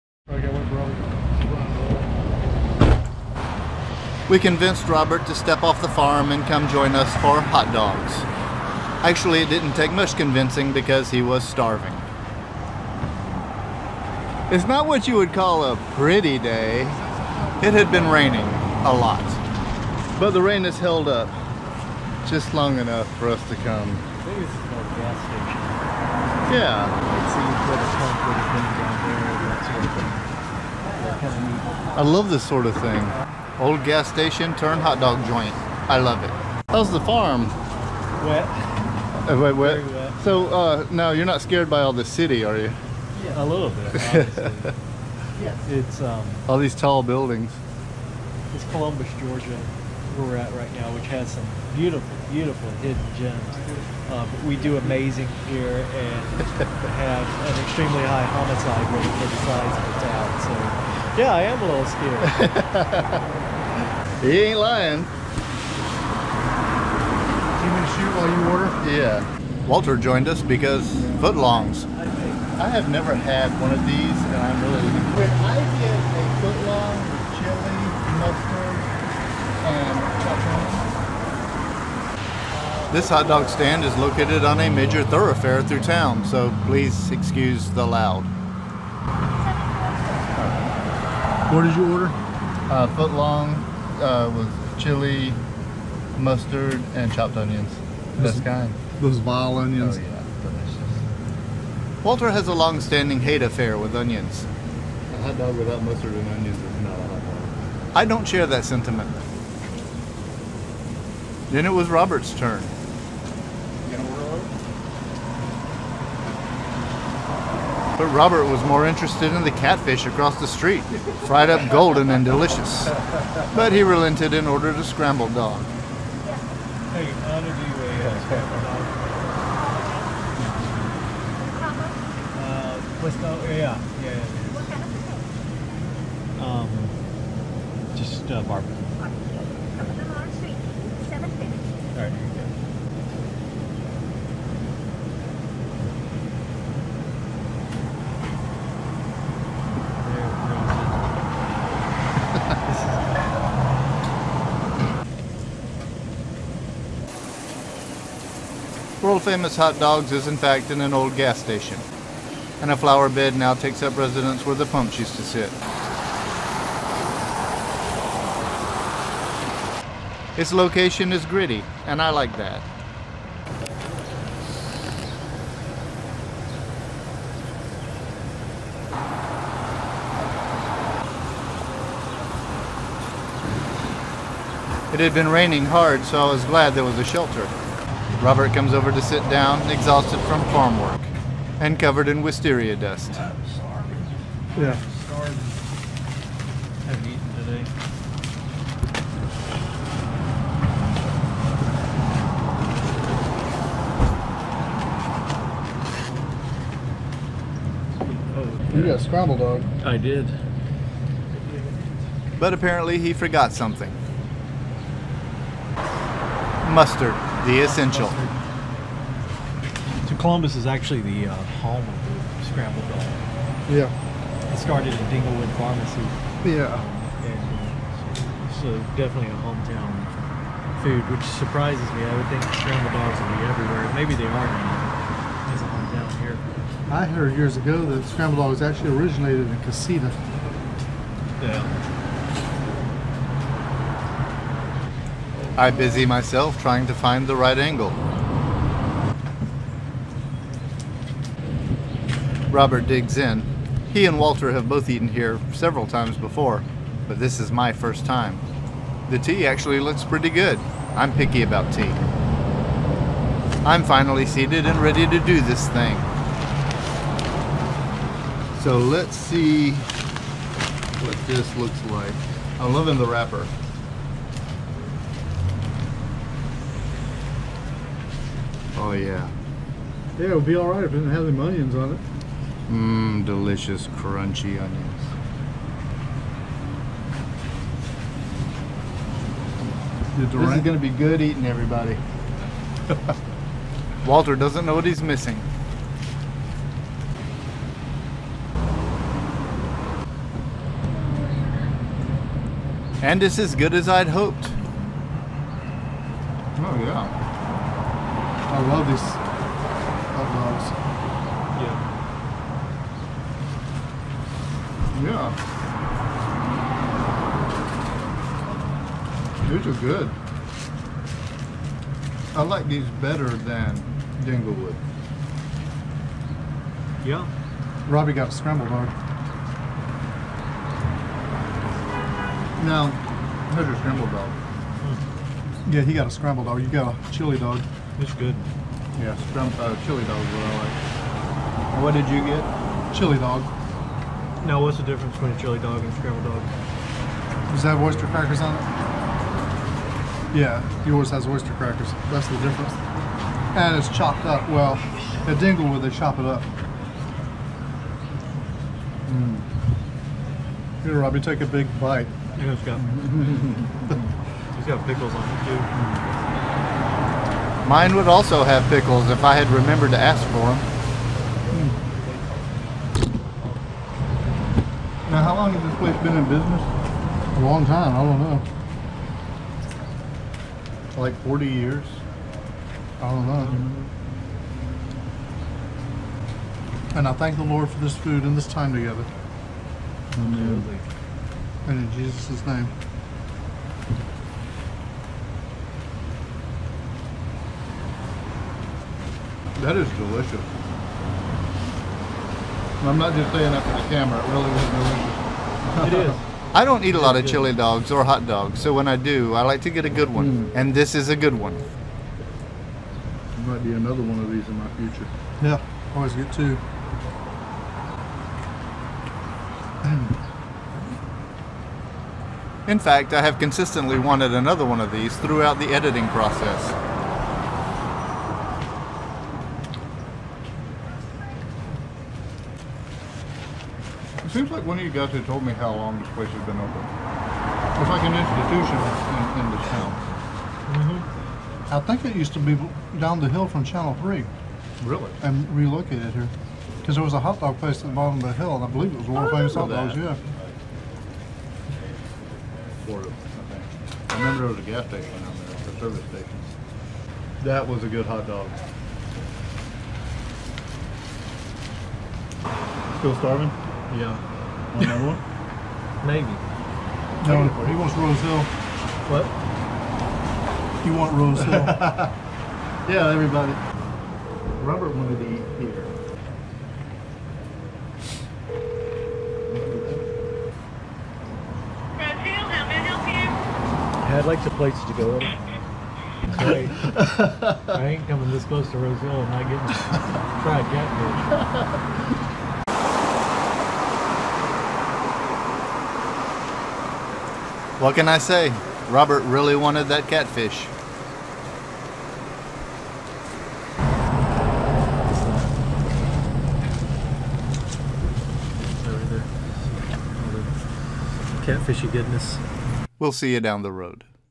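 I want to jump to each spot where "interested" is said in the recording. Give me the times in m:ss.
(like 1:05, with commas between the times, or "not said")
1:58.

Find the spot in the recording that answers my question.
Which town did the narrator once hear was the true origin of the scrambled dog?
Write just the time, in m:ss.
3:59.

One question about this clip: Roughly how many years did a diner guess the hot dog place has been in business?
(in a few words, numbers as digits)
40.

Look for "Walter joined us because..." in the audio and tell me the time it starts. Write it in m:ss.
1:09.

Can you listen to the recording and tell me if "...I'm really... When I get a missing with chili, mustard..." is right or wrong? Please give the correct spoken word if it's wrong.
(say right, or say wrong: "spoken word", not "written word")
wrong: "footlong", not "missing".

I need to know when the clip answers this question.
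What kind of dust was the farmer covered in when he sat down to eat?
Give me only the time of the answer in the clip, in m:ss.
3:12.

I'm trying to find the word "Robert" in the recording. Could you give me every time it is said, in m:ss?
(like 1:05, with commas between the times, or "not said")
0:04, 1:51, 1:58, 3:08, 4:12, 7:54, 8:18.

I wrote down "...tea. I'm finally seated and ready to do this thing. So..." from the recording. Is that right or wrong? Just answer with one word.
right.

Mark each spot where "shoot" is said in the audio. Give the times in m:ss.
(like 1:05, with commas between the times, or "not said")
1:07.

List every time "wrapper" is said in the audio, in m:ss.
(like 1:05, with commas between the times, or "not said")
4:33.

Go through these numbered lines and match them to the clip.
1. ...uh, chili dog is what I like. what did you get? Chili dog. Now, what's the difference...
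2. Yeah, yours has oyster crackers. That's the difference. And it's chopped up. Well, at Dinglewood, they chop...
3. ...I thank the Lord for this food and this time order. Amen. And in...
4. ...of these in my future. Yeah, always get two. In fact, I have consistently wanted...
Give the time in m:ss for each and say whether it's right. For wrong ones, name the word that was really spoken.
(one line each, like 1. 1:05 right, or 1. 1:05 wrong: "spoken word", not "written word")
1. 5:39 right
2. 5:50 right
3. 6:27 wrong: "together", not "order"
4. 6:54 right.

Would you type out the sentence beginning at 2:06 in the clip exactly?
Hey, Anna, do you a uh, scrambled dog?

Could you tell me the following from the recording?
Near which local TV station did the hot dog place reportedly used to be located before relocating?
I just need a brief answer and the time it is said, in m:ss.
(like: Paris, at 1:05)
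Channel 3, at 7:23.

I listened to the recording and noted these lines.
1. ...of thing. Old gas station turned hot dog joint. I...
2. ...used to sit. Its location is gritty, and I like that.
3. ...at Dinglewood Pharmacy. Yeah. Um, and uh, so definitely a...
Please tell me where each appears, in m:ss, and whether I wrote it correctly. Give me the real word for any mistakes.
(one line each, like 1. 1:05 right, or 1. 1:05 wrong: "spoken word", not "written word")
1. 0:32 right
2. 2:44 right
3. 3:44 right.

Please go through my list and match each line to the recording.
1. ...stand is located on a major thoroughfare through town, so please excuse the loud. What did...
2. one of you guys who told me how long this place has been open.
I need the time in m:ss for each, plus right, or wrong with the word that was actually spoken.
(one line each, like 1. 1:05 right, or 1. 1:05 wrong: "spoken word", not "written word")
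1. 1:23 right
2. 7:14 right.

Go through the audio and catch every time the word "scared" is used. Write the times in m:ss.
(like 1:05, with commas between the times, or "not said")
0:41, 1:01.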